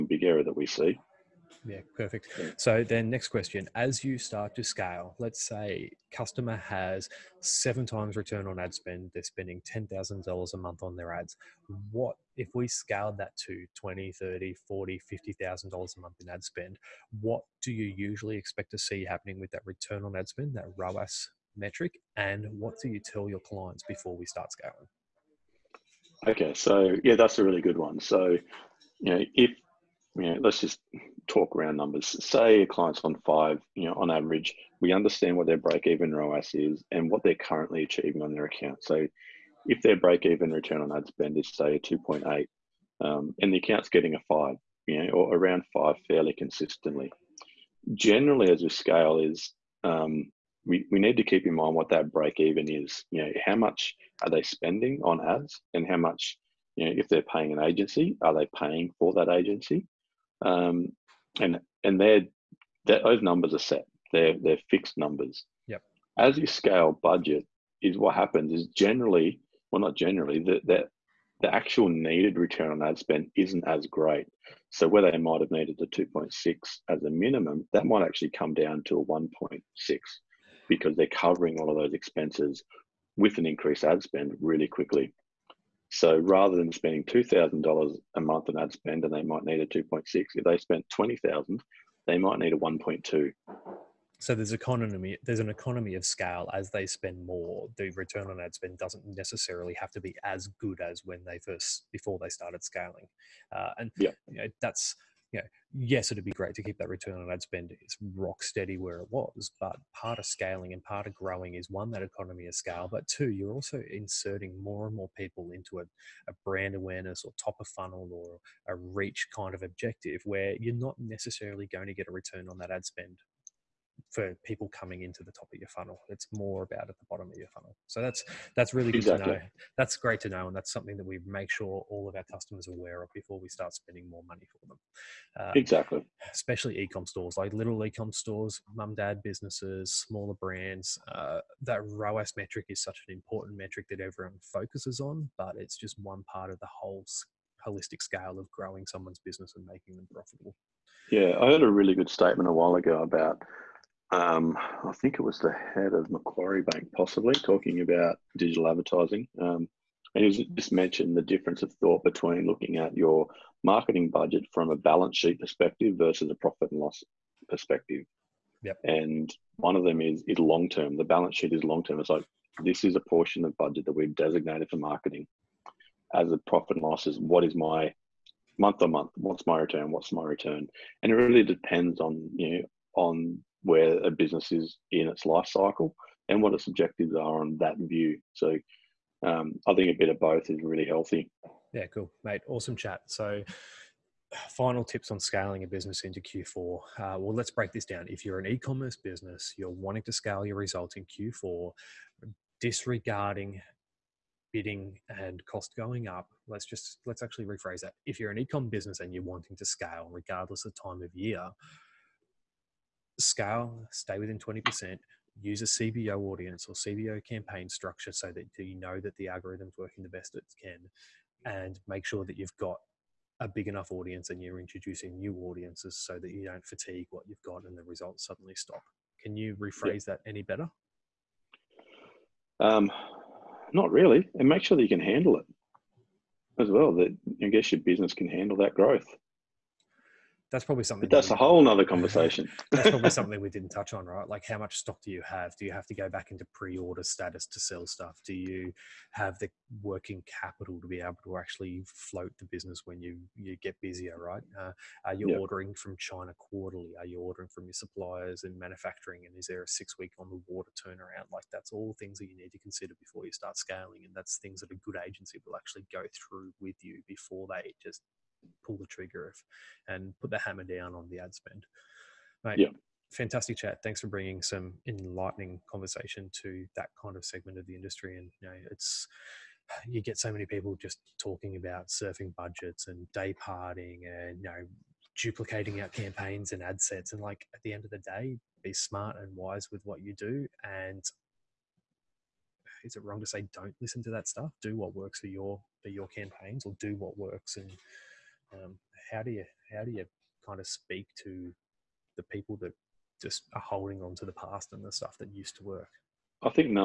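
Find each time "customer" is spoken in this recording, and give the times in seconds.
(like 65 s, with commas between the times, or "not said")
6 s, 132 s.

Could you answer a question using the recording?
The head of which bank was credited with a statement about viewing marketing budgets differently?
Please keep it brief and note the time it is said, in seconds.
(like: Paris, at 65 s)
Macquarie Bank, at 156 s.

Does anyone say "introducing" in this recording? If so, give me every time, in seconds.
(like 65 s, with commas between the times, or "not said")
224 s.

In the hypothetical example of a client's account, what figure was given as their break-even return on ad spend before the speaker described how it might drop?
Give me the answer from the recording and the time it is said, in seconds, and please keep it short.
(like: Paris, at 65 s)
2.8, at 41 s.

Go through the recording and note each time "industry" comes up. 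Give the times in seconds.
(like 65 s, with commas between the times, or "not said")
277 s.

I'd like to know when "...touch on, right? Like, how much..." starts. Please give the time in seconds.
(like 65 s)
243 s.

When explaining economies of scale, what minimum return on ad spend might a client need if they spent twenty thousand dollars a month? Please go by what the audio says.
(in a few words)
1.2.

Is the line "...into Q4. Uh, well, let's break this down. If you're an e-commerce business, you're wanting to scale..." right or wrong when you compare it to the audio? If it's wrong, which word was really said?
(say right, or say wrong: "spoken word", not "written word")
right.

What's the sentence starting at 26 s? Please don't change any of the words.
Okay, so yeah, that's a really good one.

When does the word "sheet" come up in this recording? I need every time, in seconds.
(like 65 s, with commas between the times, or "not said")
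165 s, 171 s.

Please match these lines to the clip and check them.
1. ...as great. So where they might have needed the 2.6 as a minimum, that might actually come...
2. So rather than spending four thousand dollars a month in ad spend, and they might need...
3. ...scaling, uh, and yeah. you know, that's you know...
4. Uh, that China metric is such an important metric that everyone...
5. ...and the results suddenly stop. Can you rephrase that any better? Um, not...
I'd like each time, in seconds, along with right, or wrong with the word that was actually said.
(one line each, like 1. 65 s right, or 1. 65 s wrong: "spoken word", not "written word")
1. 73 s right
2. 85 s wrong: "two", not "four"
3. 102 s right
4. 141 s wrong: "ROAS", not "China"
5. 227 s right.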